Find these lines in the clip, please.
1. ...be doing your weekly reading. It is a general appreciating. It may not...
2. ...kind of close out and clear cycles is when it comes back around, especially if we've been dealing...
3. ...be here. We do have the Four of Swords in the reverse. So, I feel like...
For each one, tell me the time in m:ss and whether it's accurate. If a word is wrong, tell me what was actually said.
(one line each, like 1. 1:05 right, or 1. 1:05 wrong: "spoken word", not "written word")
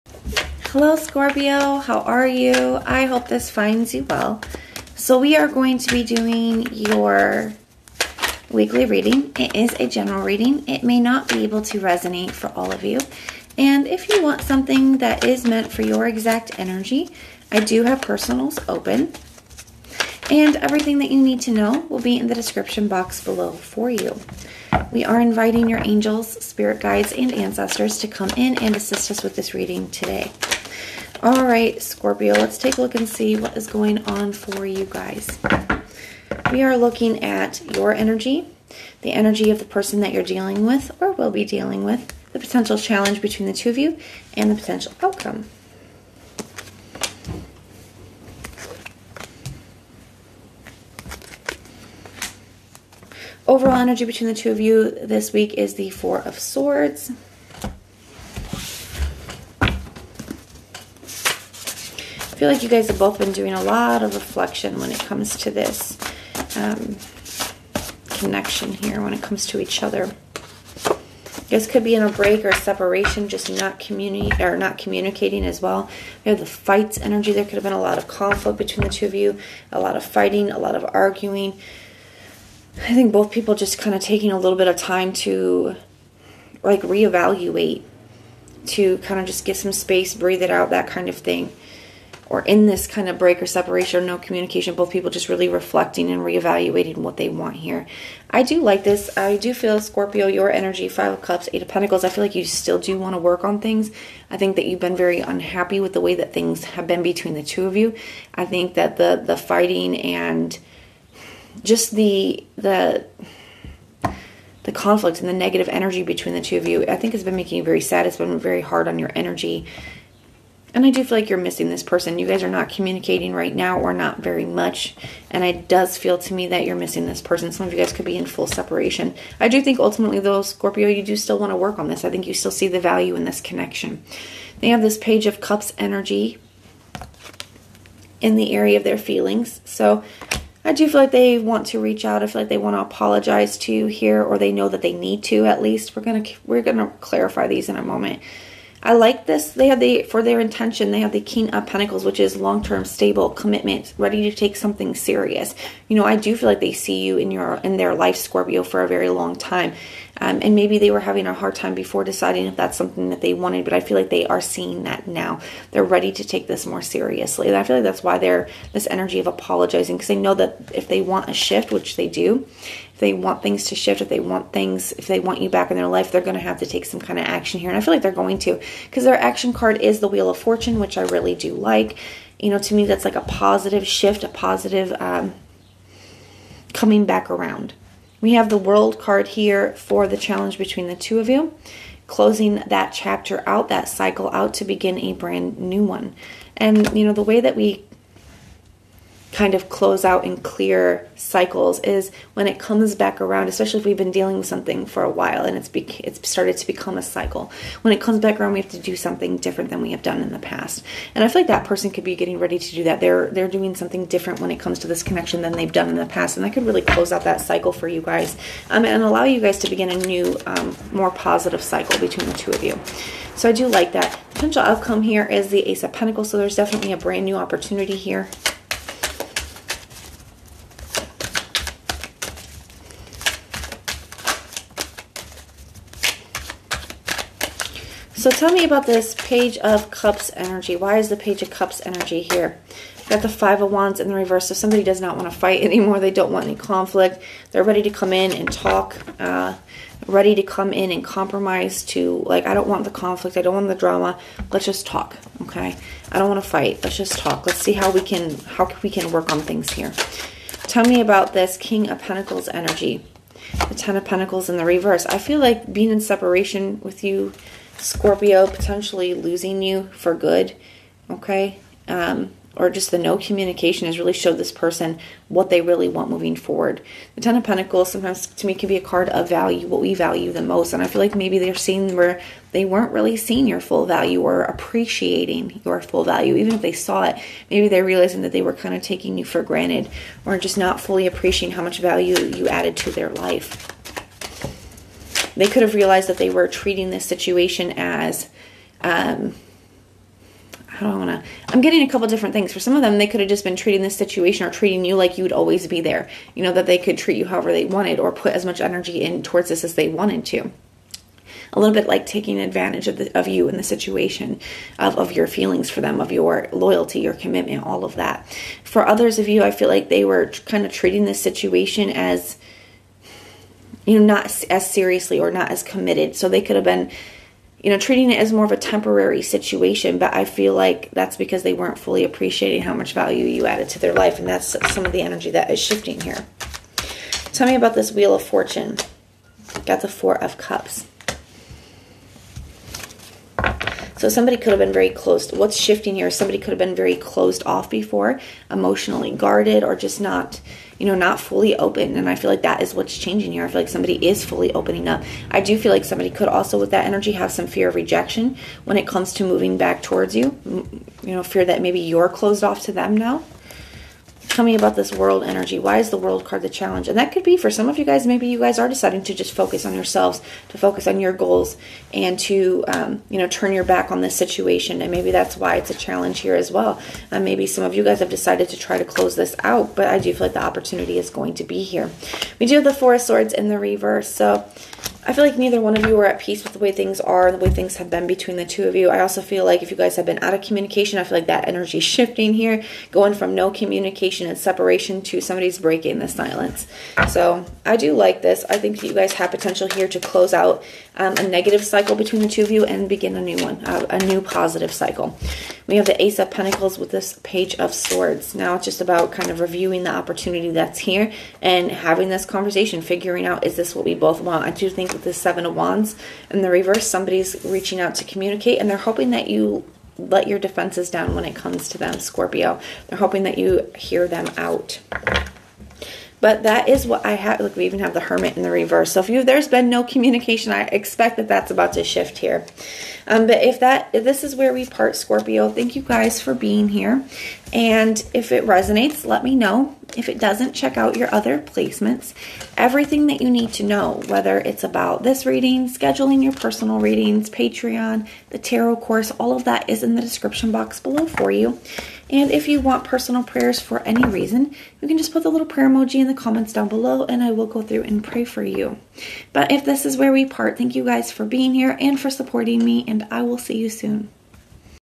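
1. 0:05 wrong: "reading", not "appreciating"
2. 3:19 right
3. 6:21 right.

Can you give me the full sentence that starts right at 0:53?
Overall energy between the two of you this week is the Four of Swords.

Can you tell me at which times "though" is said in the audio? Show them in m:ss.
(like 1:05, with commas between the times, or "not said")
2:10.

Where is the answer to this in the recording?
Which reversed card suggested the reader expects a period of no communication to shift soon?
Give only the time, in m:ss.
7:07.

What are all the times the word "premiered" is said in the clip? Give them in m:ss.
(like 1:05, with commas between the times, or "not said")
not said.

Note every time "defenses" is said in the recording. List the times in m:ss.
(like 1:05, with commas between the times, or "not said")
7:00.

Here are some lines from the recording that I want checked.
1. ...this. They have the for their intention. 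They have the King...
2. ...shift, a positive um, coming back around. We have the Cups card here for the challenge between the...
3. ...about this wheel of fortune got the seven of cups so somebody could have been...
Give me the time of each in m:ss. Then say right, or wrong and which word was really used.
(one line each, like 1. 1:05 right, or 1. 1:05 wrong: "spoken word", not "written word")
1. 2:29 right
2. 3:03 wrong: "World", not "Cups"
3. 5:37 wrong: "four", not "seven".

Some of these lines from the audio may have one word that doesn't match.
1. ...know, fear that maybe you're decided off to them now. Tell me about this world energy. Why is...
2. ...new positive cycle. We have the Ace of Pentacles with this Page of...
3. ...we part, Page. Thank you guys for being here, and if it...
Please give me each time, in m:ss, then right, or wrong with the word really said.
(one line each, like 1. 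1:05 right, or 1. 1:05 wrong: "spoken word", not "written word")
1. 6:01 wrong: "closed", not "decided"
2. 6:44 right
3. 7:14 wrong: "Scorpio", not "Page".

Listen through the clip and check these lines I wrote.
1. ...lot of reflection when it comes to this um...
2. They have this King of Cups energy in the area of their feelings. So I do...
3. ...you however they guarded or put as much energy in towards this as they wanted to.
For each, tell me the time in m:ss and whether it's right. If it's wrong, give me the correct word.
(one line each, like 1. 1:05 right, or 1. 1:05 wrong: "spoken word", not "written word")
1. 1:03 right
2. 2:14 wrong: "Page", not "King"
3. 5:07 wrong: "wanted", not "guarded".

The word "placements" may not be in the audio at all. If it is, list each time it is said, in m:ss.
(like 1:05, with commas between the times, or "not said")
7:21.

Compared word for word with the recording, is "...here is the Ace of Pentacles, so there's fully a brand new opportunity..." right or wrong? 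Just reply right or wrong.
wrong.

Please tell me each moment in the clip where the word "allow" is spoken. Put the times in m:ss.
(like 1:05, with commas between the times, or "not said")
3:39.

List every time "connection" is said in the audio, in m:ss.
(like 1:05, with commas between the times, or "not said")
1:08, 2:13, 3:35.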